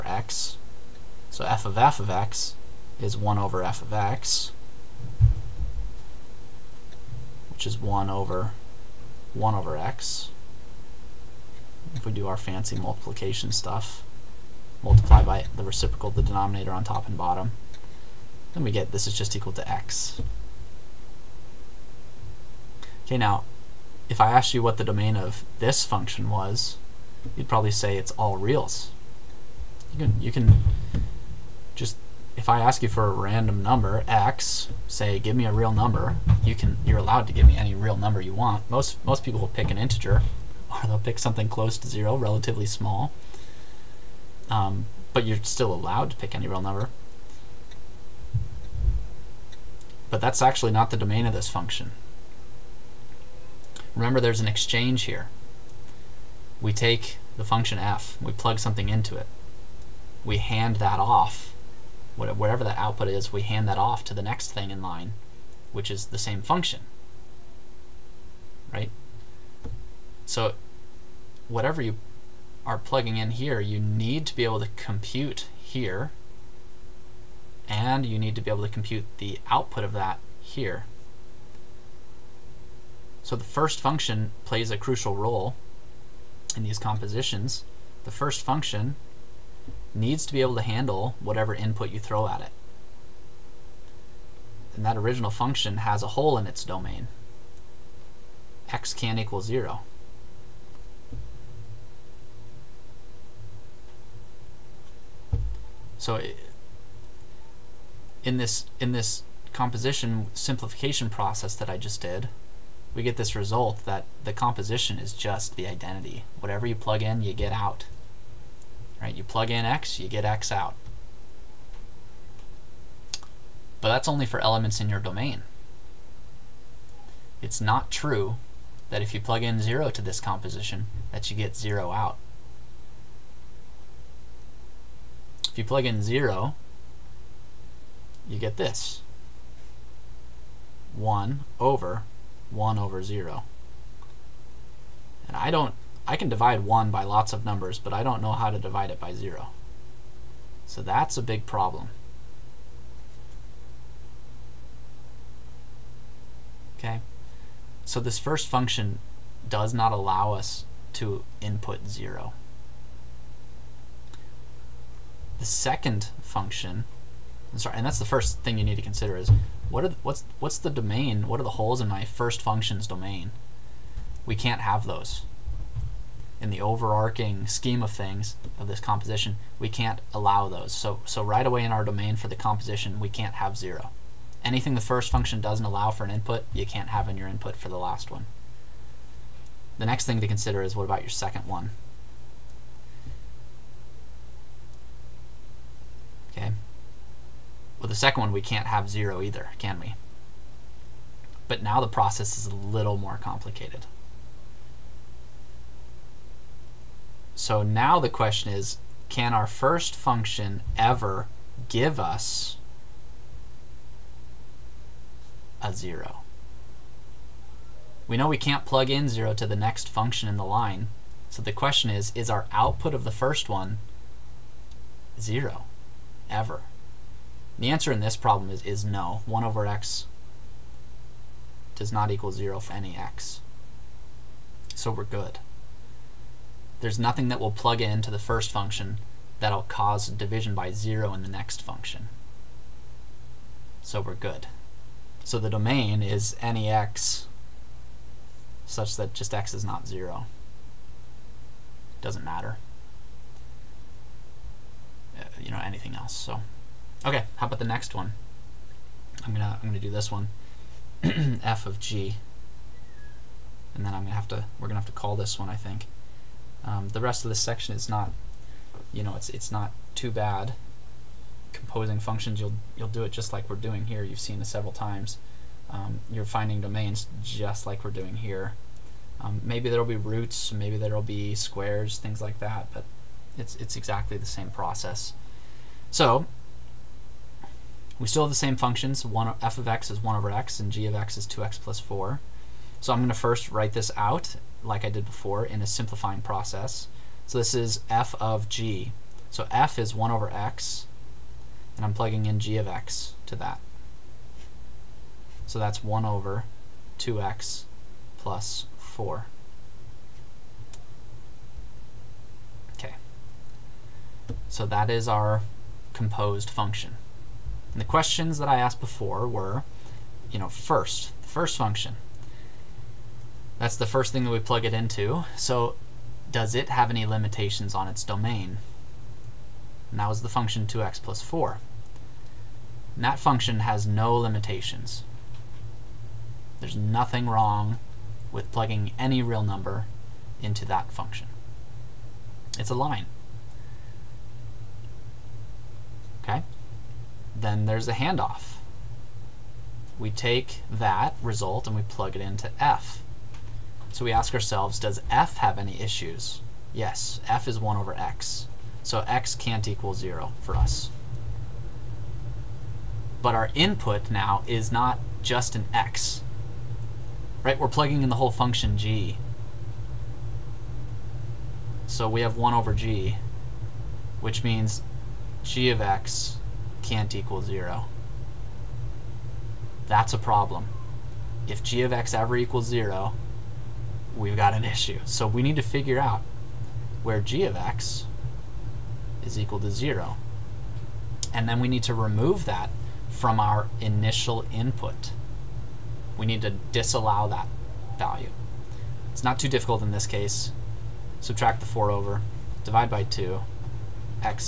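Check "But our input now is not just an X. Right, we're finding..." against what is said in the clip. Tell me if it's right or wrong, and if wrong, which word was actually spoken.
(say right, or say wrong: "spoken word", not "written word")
wrong: "plugging", not "finding".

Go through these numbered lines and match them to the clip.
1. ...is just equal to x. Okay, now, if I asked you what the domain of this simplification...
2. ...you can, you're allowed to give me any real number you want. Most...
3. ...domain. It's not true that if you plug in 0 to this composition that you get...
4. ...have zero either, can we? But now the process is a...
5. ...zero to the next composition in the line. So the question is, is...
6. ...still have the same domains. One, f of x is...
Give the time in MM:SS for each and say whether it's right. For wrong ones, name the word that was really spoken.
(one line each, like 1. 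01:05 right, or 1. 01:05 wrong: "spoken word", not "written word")
1. 00:19 wrong: "function", not "simplification"
2. 00:36 right
3. 02:04 right
4. 03:18 right
5. 03:39 wrong: "function", not "composition"
6. 04:48 wrong: "functions", not "domains".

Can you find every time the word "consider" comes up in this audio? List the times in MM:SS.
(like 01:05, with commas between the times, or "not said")
02:48, 03:10.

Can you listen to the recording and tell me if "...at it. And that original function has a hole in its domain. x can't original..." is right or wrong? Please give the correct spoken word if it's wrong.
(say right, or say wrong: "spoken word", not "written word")
wrong: "equal", not "original".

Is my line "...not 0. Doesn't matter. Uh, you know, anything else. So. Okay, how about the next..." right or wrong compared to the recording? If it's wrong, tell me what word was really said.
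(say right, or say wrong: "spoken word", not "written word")
right.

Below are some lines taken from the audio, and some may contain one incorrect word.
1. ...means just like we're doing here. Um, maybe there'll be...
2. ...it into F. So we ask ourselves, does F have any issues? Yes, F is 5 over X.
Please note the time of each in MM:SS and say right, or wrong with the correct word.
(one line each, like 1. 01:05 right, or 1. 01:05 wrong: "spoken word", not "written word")
1. 04:36 wrong: "domains", not "means"
2. 05:52 wrong: "1", not "5".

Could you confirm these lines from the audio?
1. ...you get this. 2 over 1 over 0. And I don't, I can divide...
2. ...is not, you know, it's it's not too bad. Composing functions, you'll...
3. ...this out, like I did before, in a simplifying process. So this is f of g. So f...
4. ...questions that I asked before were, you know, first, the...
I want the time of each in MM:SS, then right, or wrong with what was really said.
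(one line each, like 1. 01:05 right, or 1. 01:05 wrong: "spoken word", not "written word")
1. 02:18 wrong: "1", not "2"
2. 04:27 right
3. 04:53 right
4. 05:17 right.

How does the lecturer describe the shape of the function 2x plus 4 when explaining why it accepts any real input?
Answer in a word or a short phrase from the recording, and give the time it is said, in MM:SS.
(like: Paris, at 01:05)
a line, at 05:42.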